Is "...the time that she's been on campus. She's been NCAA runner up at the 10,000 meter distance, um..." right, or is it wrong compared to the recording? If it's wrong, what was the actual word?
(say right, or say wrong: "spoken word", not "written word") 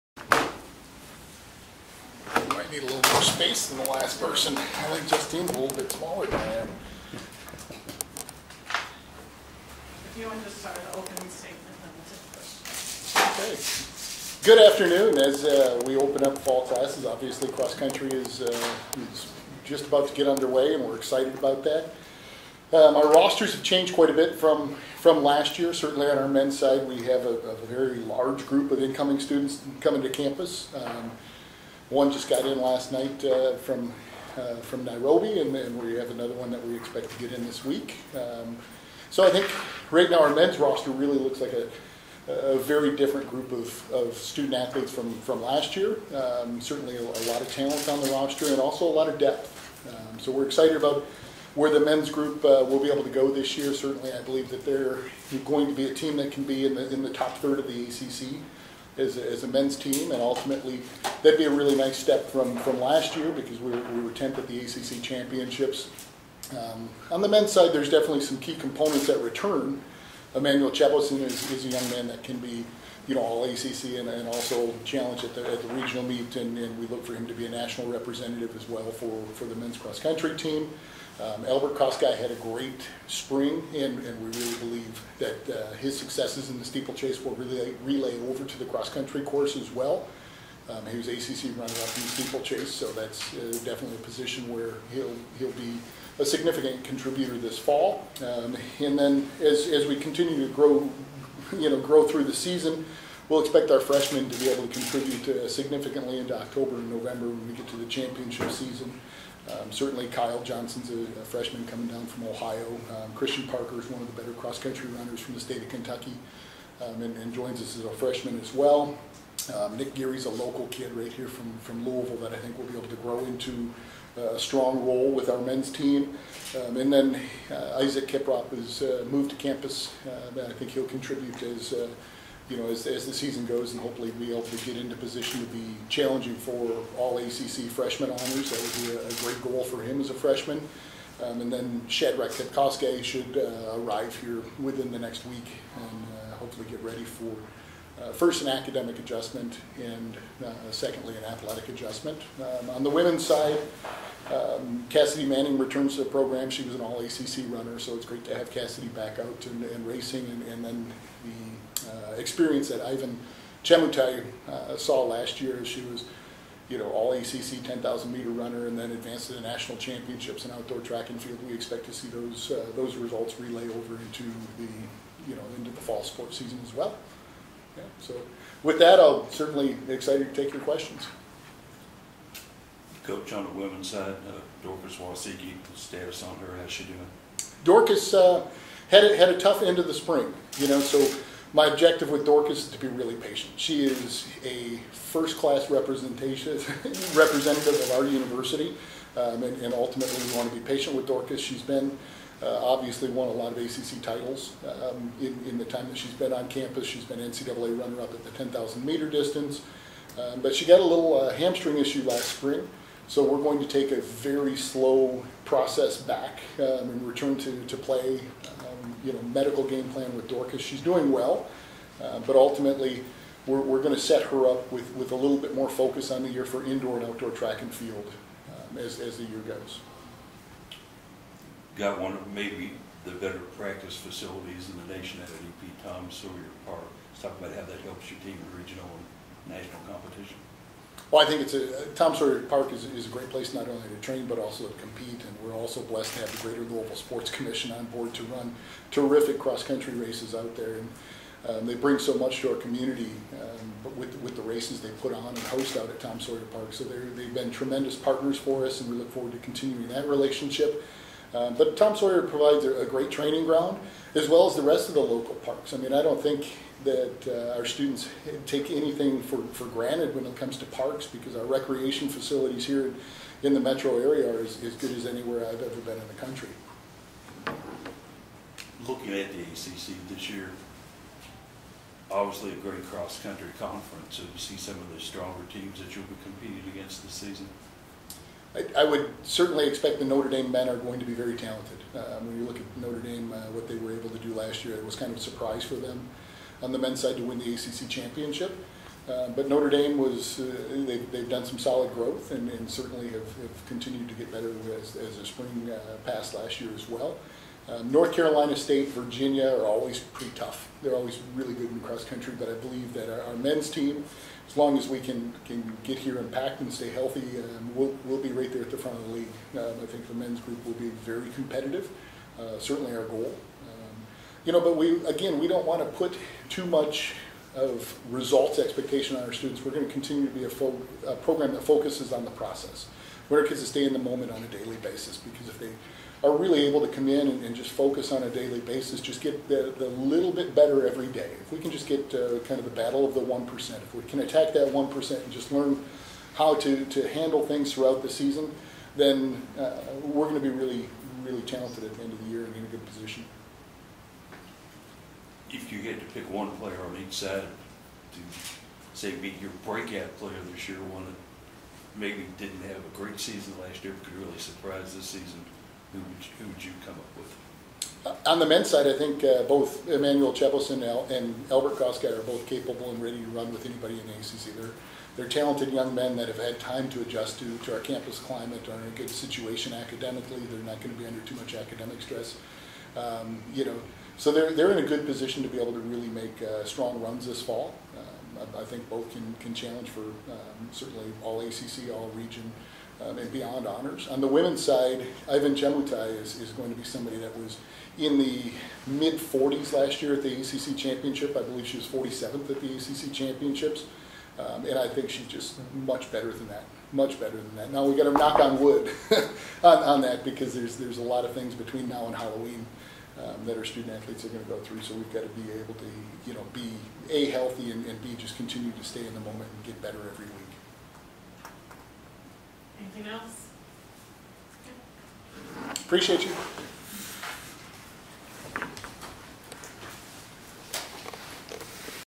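right.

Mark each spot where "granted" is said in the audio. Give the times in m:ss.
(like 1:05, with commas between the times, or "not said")
4:29.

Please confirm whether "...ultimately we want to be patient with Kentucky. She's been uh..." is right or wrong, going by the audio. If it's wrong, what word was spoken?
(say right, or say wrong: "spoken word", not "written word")
wrong: "Dorcas", not "Kentucky".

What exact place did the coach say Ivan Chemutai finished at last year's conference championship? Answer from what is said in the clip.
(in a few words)
47th.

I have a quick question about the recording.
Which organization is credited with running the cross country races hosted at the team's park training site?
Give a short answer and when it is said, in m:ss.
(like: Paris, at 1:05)
Greater Louisville Sports Commission, at 4:06.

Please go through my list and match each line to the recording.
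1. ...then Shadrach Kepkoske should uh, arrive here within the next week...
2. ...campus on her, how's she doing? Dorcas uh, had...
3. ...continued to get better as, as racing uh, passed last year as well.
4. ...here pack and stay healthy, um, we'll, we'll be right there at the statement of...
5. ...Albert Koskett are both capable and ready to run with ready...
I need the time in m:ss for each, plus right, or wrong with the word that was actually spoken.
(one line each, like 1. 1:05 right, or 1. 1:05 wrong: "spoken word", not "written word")
1. 2:21 right
2. 3:05 wrong: "status", not "campus"
3. 5:03 wrong: "spring", not "racing"
4. 5:15 wrong: "front", not "statement"
5. 6:11 wrong: "anybody", not "ready".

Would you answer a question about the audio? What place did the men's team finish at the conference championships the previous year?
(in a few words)
10th.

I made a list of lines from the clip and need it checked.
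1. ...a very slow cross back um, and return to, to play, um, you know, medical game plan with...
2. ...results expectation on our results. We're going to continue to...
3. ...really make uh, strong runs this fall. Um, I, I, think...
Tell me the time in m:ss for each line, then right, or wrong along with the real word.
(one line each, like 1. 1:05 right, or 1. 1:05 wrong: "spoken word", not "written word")
1. 3:33 wrong: "process", not "cross"
2. 5:28 wrong: "students", not "results"
3. 6:25 right.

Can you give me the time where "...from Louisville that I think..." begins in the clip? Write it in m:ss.
2:01.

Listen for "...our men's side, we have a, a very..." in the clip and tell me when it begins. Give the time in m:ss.
0:26.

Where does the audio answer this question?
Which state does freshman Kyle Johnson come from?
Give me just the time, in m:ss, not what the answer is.
1:52.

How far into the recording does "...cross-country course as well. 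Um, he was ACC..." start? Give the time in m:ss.
1:28.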